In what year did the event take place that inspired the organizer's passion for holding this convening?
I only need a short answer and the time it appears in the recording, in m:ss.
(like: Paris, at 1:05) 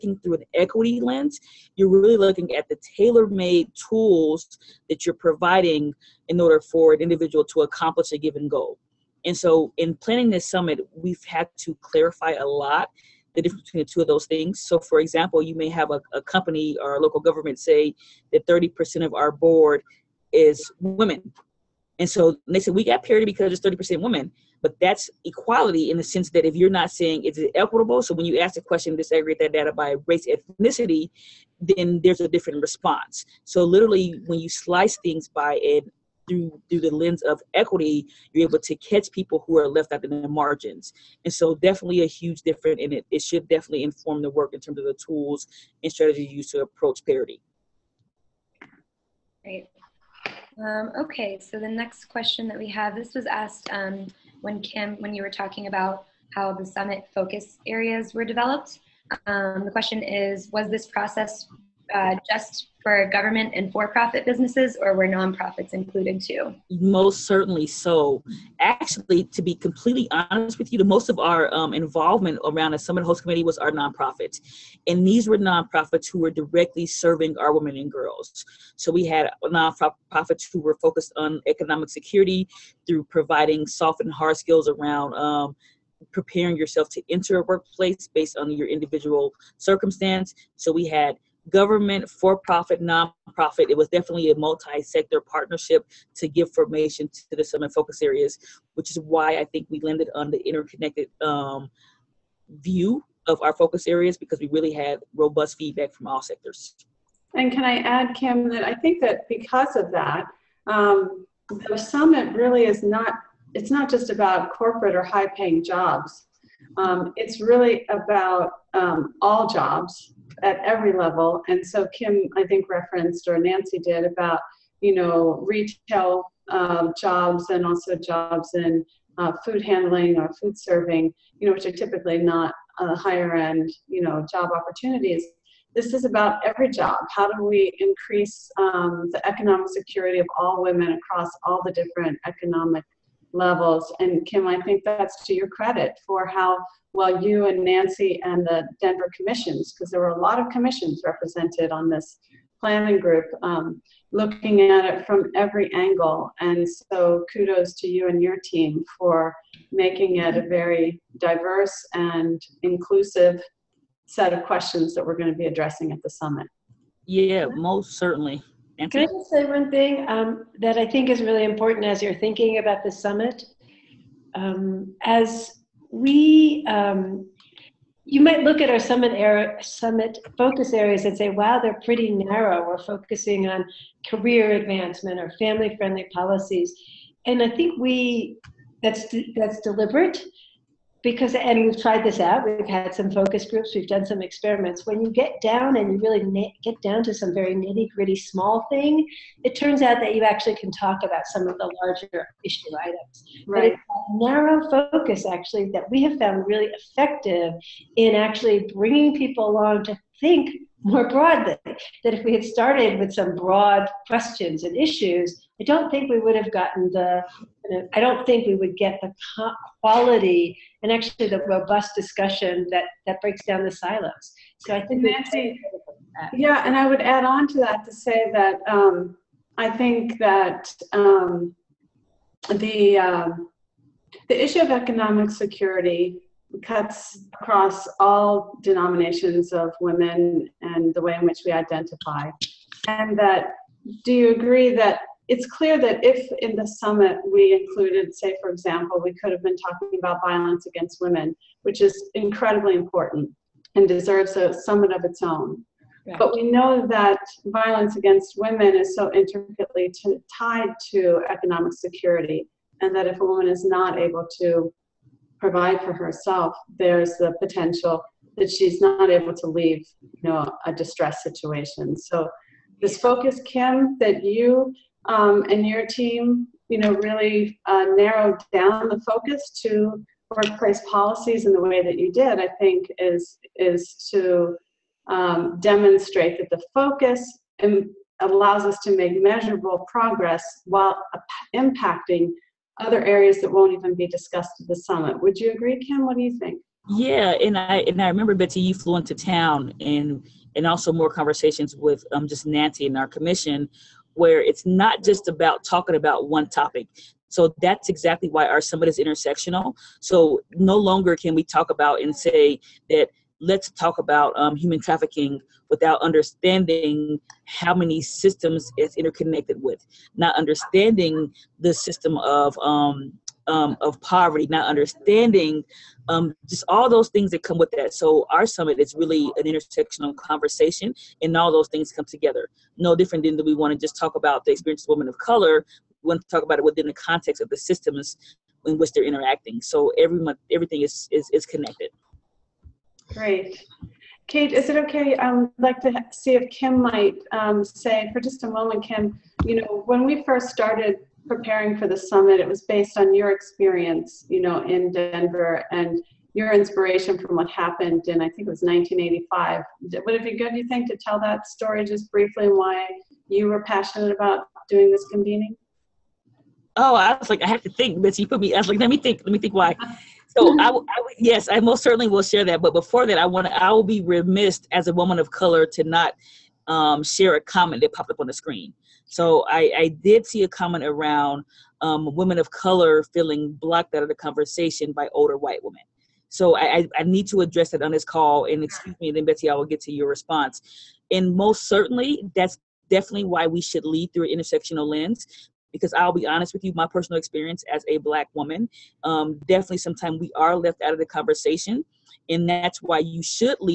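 1985, at 5:58.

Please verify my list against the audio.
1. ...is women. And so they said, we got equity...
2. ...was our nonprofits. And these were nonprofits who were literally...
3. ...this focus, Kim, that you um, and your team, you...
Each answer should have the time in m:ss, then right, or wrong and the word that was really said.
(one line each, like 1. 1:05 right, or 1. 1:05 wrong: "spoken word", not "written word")
1. 0:20 wrong: "parity", not "equity"
2. 1:13 wrong: "directly", not "literally"
3. 4:32 right.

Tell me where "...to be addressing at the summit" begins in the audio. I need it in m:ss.
2:45.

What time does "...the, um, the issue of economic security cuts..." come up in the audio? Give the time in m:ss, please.
3:52.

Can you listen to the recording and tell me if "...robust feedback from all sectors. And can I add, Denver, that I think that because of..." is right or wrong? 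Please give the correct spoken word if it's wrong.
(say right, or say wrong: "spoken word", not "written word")
wrong: "Kim", not "Denver".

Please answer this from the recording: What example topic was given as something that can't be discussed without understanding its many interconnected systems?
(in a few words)
human trafficking.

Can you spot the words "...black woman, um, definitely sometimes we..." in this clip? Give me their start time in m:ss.
6:37.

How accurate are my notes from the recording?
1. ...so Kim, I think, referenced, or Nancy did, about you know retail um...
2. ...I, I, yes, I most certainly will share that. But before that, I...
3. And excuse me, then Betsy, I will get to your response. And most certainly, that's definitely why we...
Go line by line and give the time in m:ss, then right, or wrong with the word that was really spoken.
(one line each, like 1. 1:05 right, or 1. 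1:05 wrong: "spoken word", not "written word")
1. 2:01 right
2. 6:10 right
3. 6:28 right.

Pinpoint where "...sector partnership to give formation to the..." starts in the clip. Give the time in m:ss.
1:34.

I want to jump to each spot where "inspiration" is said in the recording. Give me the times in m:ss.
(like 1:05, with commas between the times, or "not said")
5:56.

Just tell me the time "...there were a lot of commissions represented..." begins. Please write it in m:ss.
2:29.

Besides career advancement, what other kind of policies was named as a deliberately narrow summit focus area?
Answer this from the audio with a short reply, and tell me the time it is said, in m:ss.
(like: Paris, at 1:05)
family friendly policies, at 3:05.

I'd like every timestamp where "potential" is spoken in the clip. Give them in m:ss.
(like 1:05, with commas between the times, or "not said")
4:27.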